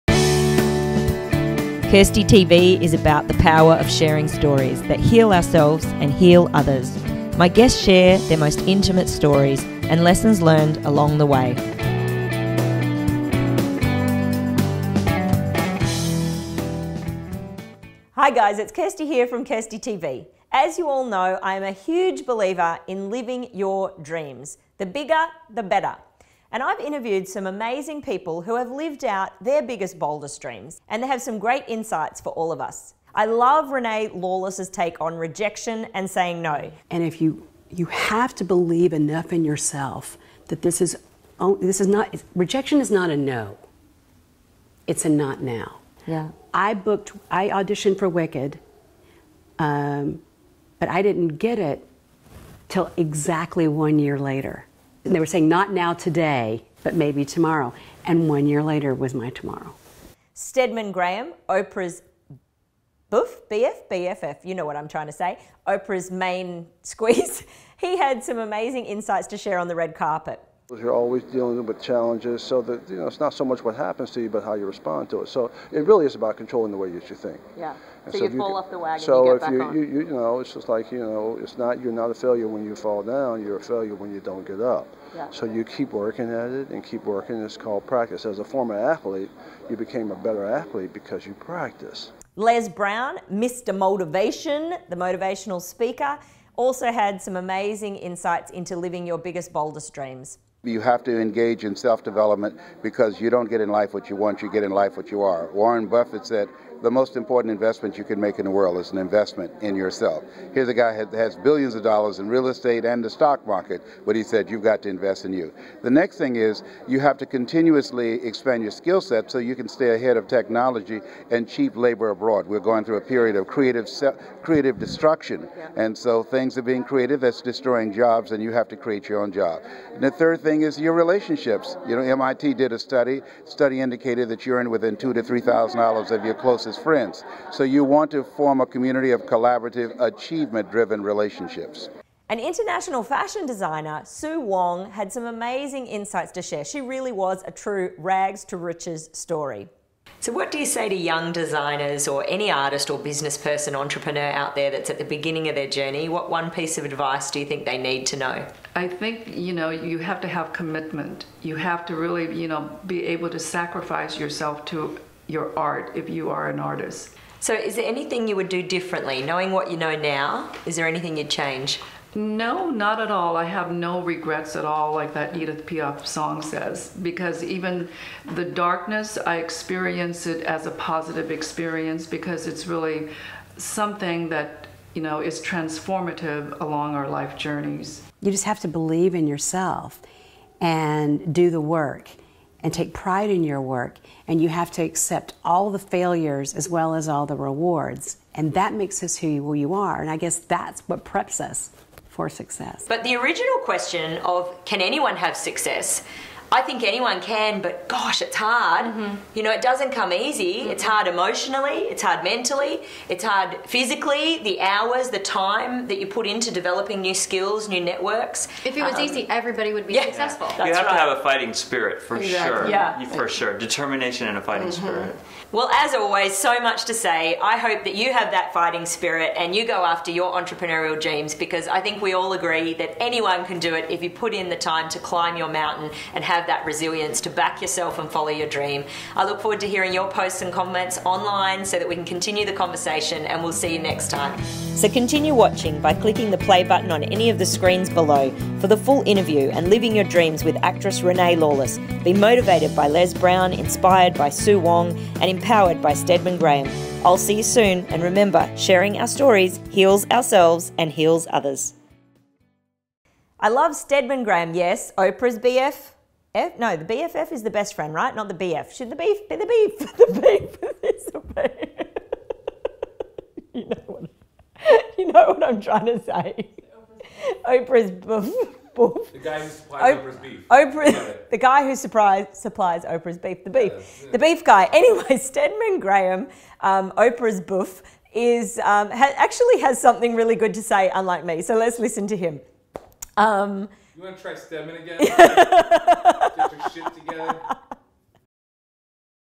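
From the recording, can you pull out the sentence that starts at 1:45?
Warren Buffett said, The most important investment you can make in the world is an investment in yourself.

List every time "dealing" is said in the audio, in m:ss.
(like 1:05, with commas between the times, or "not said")
1:11.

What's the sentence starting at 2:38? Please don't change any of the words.
I think, you know, you have to have commitment.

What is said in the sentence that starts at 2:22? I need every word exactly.
An international fashion designer, Sue Wong, had some amazing insights to share.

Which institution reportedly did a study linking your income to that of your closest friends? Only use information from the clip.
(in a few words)
MIT.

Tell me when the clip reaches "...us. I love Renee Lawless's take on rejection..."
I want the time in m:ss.
0:32.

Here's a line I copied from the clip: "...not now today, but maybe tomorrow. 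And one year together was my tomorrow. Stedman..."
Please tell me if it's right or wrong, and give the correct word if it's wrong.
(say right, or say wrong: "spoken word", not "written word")
wrong: "later", not "together".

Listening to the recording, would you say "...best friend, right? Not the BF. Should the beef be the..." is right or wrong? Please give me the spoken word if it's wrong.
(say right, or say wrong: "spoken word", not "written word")
right.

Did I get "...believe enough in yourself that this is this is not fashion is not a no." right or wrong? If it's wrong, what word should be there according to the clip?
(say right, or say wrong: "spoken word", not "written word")
wrong: "rejection", not "fashion".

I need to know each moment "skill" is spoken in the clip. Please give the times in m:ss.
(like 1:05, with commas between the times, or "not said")
1:58, 3:37.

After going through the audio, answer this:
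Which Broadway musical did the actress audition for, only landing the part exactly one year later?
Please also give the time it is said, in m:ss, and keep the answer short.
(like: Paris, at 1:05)
Wicked, at 0:48.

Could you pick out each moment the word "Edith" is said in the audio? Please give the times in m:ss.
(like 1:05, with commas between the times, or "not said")
2:55.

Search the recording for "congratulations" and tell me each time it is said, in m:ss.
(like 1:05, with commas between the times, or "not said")
not said.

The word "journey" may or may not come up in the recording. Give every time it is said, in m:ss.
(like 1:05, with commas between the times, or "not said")
2:35, 3:07.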